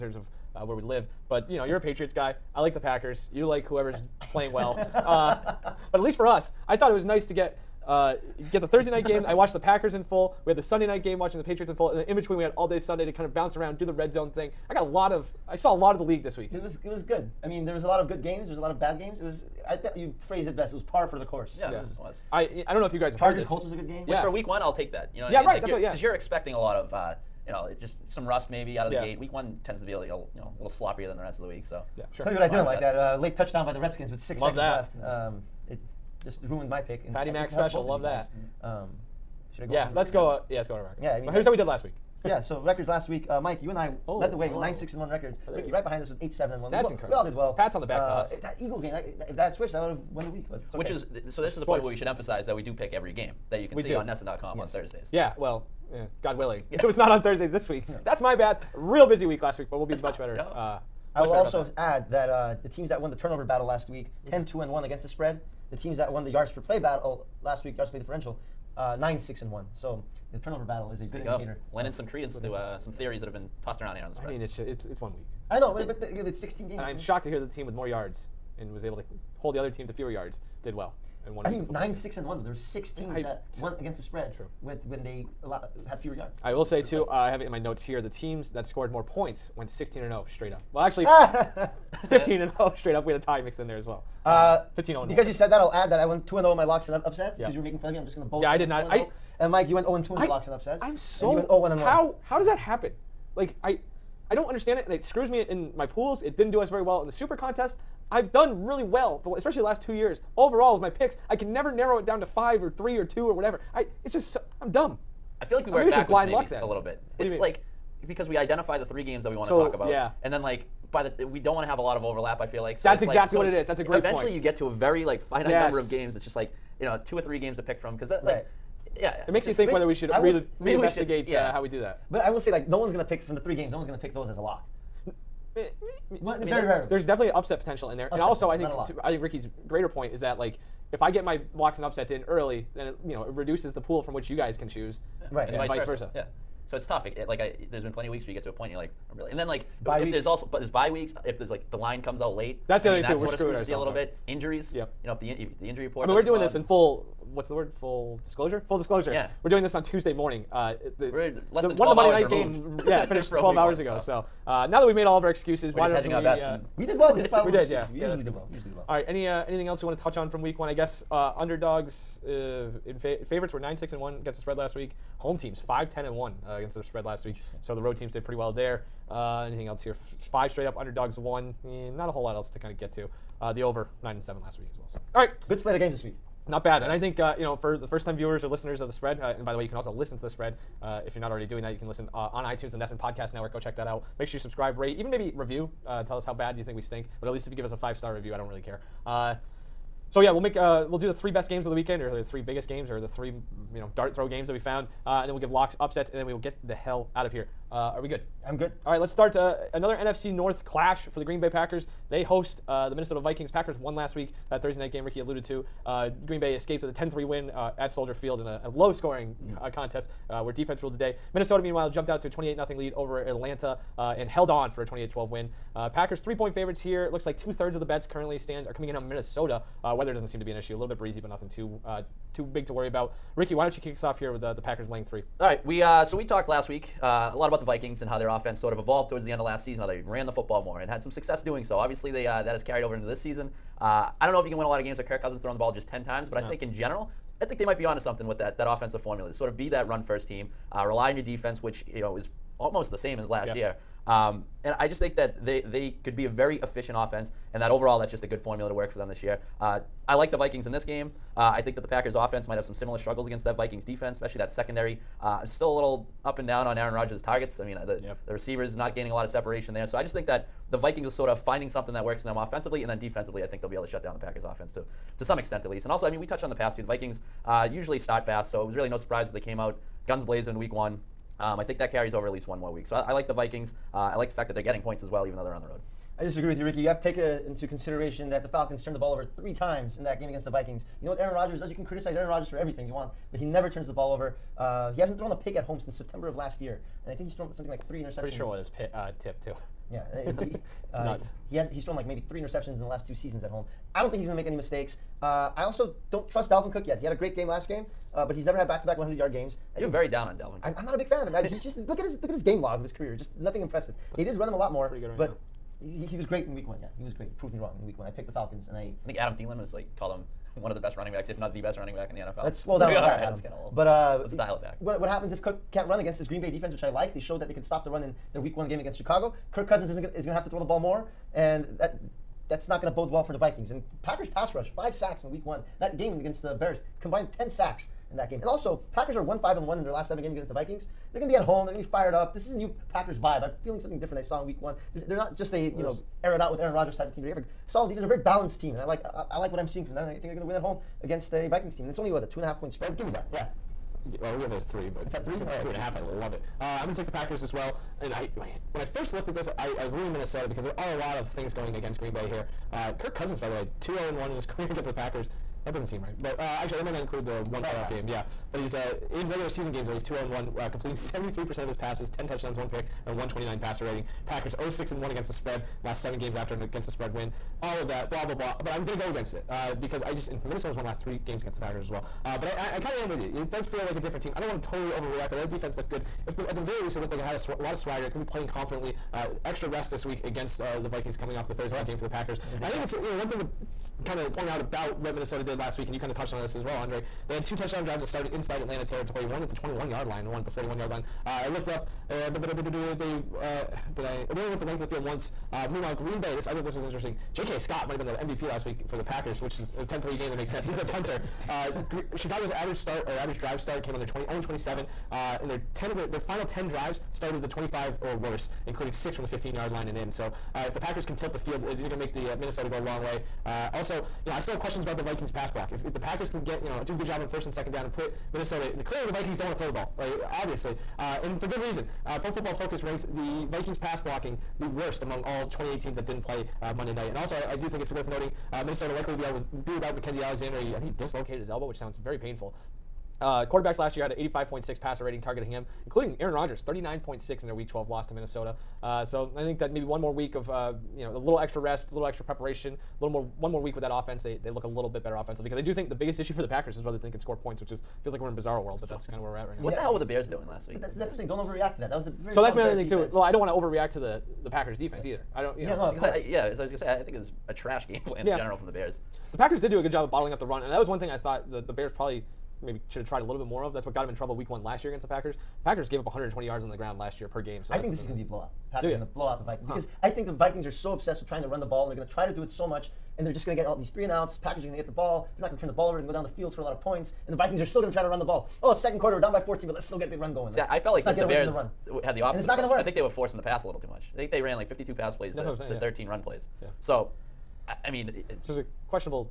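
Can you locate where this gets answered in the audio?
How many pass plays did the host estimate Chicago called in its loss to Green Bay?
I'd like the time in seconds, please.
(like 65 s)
494 s.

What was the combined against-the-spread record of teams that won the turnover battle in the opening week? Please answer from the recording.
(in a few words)
10-2-1.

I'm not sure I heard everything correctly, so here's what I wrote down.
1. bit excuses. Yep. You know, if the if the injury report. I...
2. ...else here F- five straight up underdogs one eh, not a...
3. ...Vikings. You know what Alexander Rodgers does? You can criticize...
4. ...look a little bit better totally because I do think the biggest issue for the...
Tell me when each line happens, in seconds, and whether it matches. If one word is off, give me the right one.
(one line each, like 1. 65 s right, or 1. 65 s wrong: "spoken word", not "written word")
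1. 153 s wrong: "injuries", not "excuses"
2. 179 s right
3. 290 s wrong: "Aaron", not "Alexander"
4. 454 s wrong: "offensively", not "totally".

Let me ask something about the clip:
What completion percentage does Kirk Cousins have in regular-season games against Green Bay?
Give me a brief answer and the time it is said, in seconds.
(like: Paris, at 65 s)
73%, at 370 s.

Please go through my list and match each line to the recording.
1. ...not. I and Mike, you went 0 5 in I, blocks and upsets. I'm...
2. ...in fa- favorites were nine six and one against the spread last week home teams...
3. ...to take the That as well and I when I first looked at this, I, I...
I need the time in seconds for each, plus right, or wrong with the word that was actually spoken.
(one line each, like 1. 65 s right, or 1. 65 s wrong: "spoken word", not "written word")
1. 98 s wrong: "2", not "5"
2. 172 s right
3. 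356 s wrong: "Packers", not "That".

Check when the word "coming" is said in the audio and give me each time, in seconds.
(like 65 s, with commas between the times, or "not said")
228 s, 391 s.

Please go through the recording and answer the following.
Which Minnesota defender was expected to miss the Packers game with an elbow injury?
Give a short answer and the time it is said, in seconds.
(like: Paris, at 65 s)
Mackensie Alexander, at 439 s.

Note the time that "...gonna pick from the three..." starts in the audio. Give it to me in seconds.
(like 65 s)
132 s.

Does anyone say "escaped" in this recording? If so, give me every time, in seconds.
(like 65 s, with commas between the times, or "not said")
216 s.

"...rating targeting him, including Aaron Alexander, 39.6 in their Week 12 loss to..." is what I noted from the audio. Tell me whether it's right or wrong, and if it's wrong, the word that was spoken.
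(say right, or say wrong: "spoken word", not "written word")
wrong: "Rodgers", not "Alexander".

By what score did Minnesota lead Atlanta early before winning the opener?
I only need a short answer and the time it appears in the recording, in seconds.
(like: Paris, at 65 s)
28-0, at 222 s.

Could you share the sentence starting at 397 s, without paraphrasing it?
They had two touchdown drives that started inside Atlanta territory, one at the 21 yard line, one at the 41 yard line.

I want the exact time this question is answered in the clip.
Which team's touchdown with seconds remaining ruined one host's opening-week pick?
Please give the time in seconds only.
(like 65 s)
33 s.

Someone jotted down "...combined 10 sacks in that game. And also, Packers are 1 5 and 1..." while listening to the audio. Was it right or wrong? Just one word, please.
right.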